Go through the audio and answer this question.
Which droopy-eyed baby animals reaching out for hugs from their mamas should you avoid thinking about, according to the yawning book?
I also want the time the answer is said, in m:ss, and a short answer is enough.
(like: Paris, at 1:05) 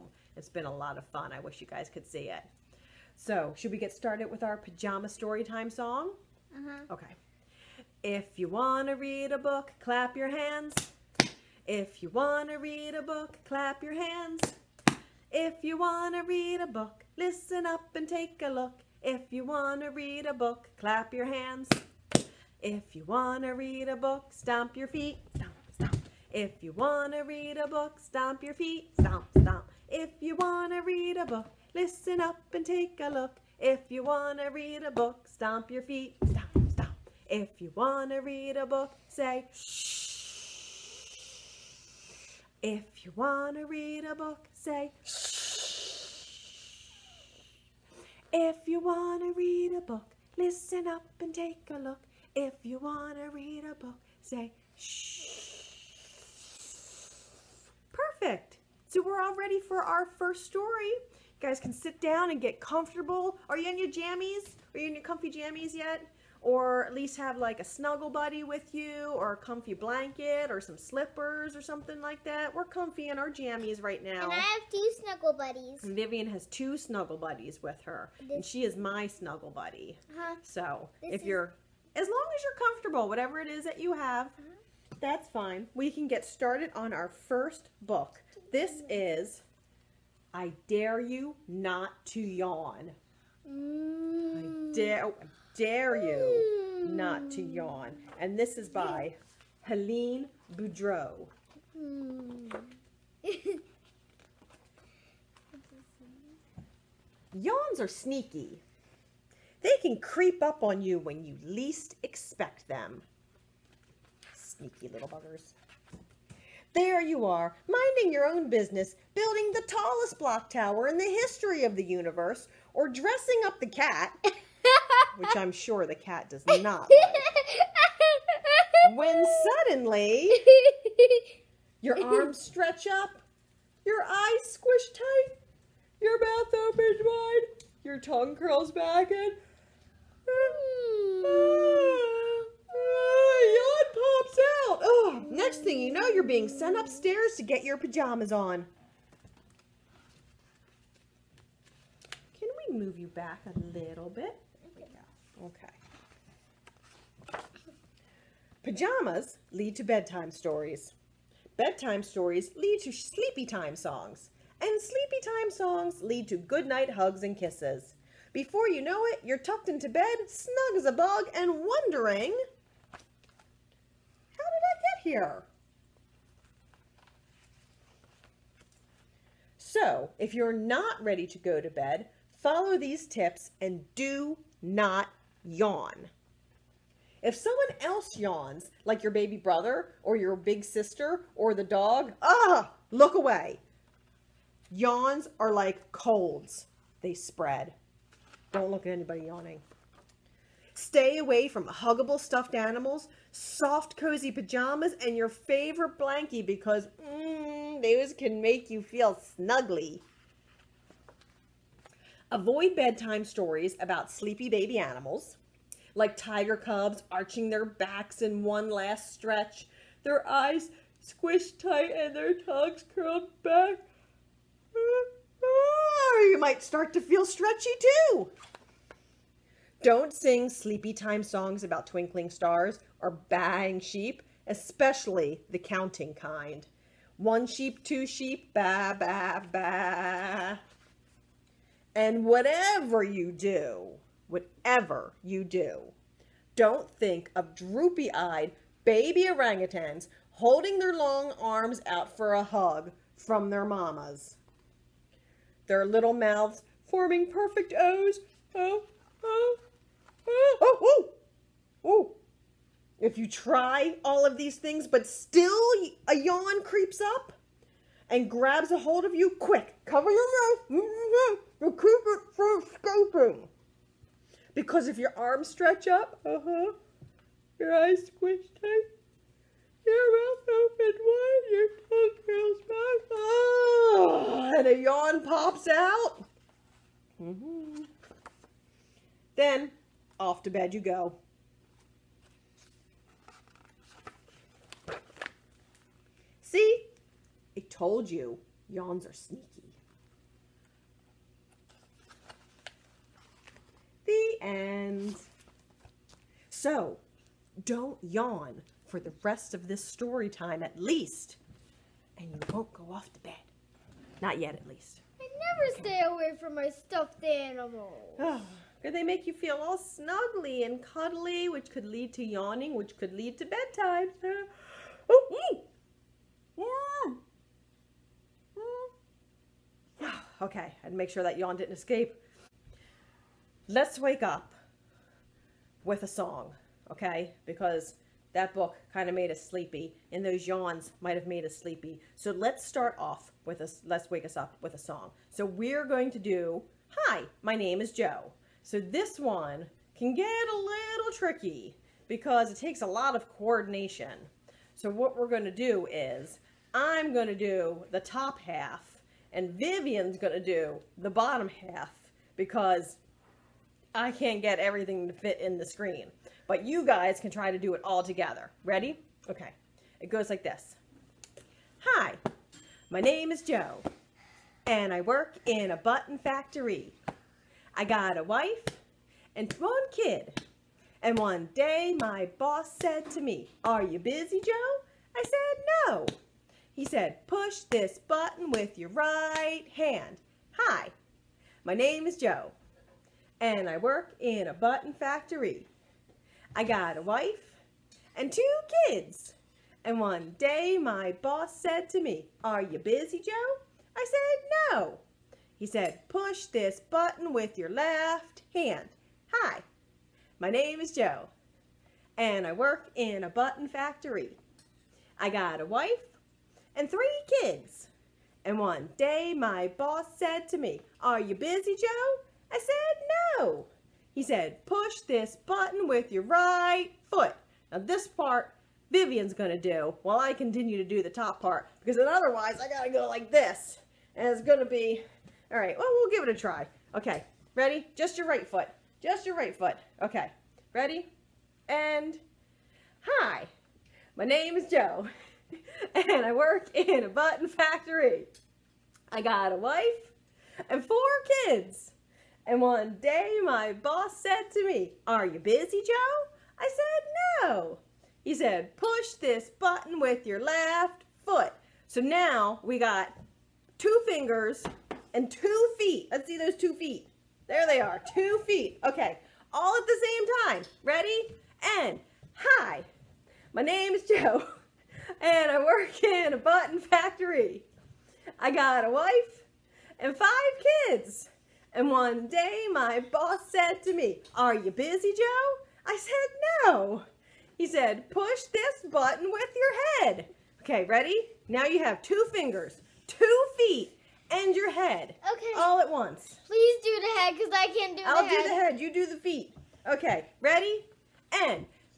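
Orangutans, at 4:08.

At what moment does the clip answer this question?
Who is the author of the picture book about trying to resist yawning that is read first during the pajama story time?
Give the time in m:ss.
1:39.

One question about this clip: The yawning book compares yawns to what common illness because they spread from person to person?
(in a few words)
Colds.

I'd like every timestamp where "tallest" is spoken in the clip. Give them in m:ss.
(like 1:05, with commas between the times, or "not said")
1:59.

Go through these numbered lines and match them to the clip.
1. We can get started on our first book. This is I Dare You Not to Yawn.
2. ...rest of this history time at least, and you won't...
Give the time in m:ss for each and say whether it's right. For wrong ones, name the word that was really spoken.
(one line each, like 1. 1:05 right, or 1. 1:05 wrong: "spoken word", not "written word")
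1. 1:25 right
2. 5:09 wrong: "story", not "history".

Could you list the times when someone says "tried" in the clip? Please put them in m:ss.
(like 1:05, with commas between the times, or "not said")
not said.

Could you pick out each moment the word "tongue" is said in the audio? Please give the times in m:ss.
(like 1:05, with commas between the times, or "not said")
2:17, 3:42, 4:41.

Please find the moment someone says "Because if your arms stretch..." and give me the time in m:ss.
4:34.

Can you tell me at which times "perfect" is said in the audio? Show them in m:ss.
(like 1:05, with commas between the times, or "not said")
0:57, 4:17.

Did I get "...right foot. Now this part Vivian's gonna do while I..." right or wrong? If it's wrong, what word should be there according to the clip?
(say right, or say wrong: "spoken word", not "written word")
right.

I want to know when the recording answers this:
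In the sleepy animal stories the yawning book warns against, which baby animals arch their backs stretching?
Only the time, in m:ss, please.
3:36.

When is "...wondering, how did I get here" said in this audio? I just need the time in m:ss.
2:51.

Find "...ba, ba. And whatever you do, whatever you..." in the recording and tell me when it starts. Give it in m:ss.
3:58.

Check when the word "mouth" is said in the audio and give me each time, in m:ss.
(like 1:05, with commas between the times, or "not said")
2:16, 4:16, 4:30, 4:40.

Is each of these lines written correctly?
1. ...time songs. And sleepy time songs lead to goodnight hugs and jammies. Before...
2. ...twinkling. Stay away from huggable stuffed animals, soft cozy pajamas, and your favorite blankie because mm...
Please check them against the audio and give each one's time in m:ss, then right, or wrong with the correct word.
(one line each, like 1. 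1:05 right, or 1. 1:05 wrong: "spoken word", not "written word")
1. 2:43 wrong: "kisses", not "jammies"
2. 3:19 wrong: "yawning", not "twinkling".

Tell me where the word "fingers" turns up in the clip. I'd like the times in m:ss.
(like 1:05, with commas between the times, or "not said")
7:44, 8:12.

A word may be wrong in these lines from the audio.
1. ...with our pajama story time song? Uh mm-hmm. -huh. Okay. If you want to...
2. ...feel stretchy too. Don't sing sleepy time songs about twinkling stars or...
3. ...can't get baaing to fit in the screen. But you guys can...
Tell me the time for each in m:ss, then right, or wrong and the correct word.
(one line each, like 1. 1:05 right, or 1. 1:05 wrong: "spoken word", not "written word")
1. 0:04 right
2. 3:47 right
3. 6:04 wrong: "everything", not "baaing".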